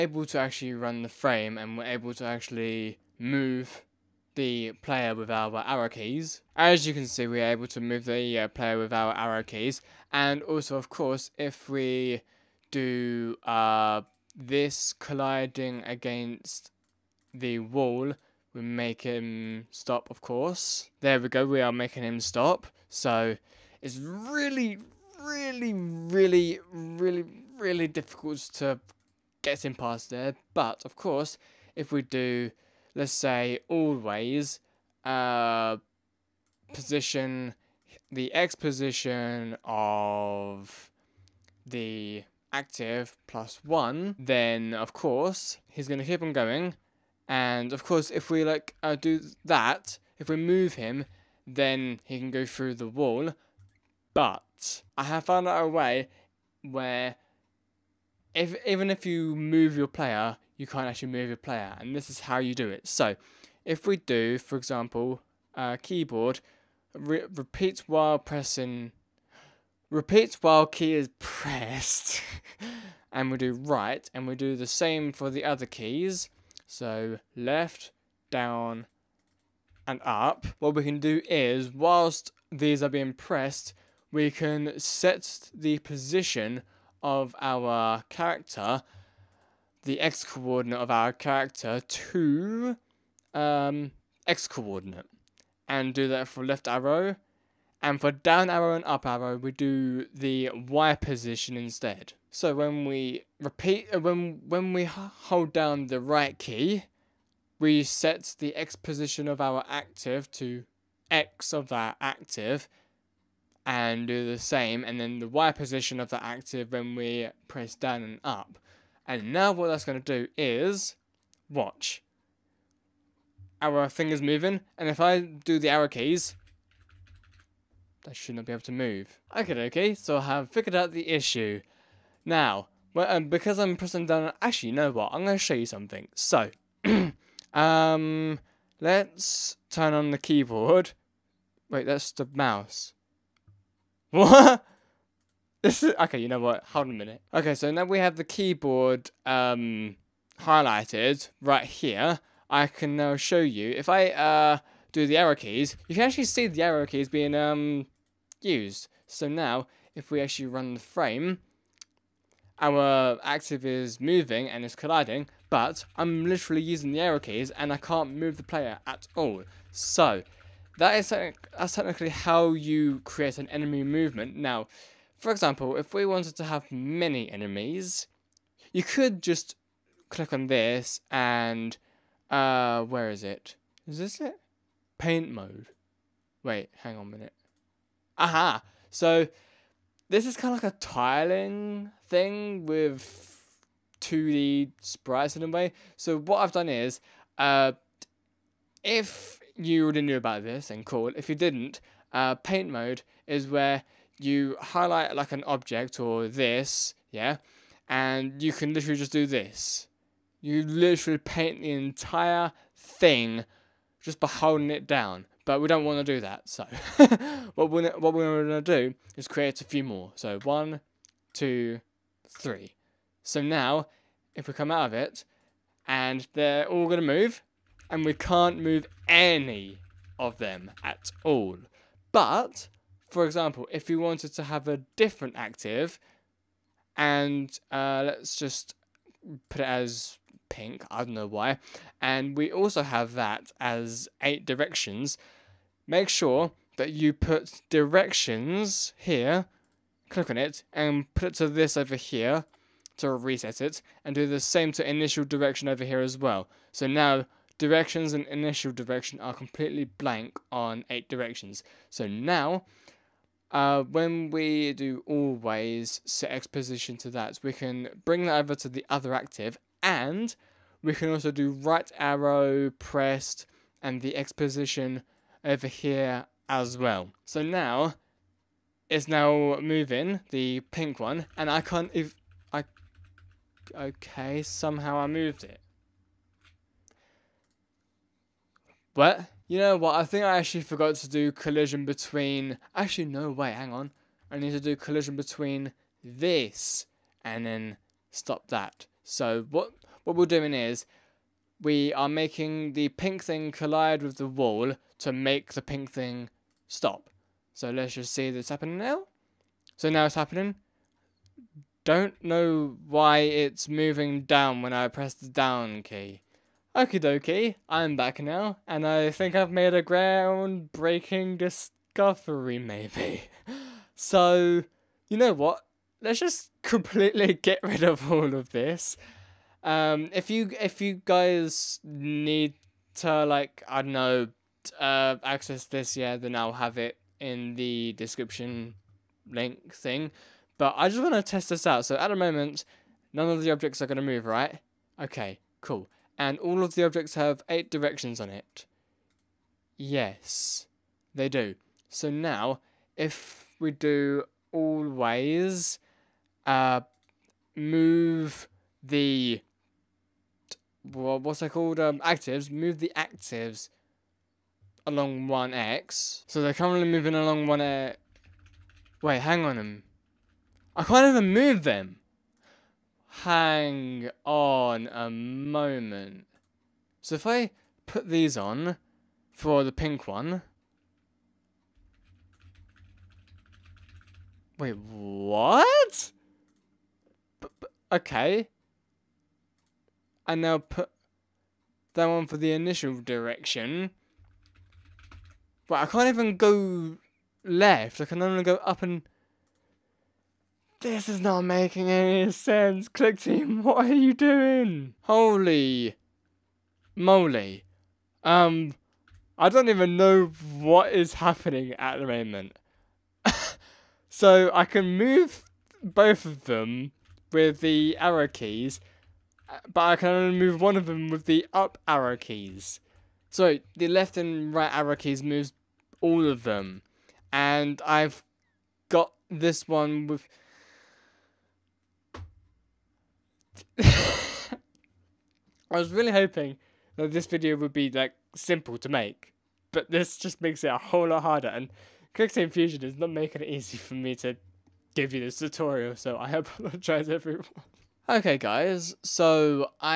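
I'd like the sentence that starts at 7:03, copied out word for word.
So the left and right arrow keys moves all of them, and I've got this one with.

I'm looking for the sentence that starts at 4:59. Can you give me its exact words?
So what what we're doing is we are making the pink thing collide with the wall to make the pink thing stop.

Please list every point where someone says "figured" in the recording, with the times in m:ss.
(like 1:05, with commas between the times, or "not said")
2:10.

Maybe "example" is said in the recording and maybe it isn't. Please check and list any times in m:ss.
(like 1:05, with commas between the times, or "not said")
1:04, 2:55, 3:53.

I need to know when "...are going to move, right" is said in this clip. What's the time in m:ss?
5:43.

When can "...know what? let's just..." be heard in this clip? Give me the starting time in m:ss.
5:25.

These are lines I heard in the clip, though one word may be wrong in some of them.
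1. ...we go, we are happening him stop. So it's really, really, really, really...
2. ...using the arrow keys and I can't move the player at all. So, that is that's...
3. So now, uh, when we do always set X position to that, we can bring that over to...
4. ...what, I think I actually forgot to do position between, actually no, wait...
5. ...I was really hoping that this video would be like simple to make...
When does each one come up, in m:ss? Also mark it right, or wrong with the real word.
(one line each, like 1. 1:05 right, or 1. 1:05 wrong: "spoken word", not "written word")
1. 0:21 wrong: "making", not "happening"
2. 2:46 right
3. 4:21 right
4. 4:49 wrong: "collision", not "position"
5. 7:13 right.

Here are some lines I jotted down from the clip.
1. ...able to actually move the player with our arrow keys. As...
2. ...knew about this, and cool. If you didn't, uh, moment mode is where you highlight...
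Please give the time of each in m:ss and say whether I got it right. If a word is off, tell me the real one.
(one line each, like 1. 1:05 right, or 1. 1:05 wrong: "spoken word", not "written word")
1. 0:01 right
2. 3:20 wrong: "paint", not "moment".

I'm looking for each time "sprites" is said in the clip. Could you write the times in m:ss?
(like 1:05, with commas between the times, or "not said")
3:14.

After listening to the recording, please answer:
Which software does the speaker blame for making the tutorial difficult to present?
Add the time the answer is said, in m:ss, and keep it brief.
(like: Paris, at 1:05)
Clickteam Fusion, at 7:22.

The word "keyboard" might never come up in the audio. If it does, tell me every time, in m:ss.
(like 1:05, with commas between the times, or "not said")
1:05, 2:20, 2:28.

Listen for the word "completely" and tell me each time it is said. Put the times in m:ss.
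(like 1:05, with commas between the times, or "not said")
4:19, 5:26.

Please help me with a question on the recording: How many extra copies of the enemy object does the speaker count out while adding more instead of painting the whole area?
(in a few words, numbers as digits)
3.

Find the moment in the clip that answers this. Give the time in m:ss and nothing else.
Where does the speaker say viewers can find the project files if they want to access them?
5:37.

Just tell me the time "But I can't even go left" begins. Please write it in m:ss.
6:35.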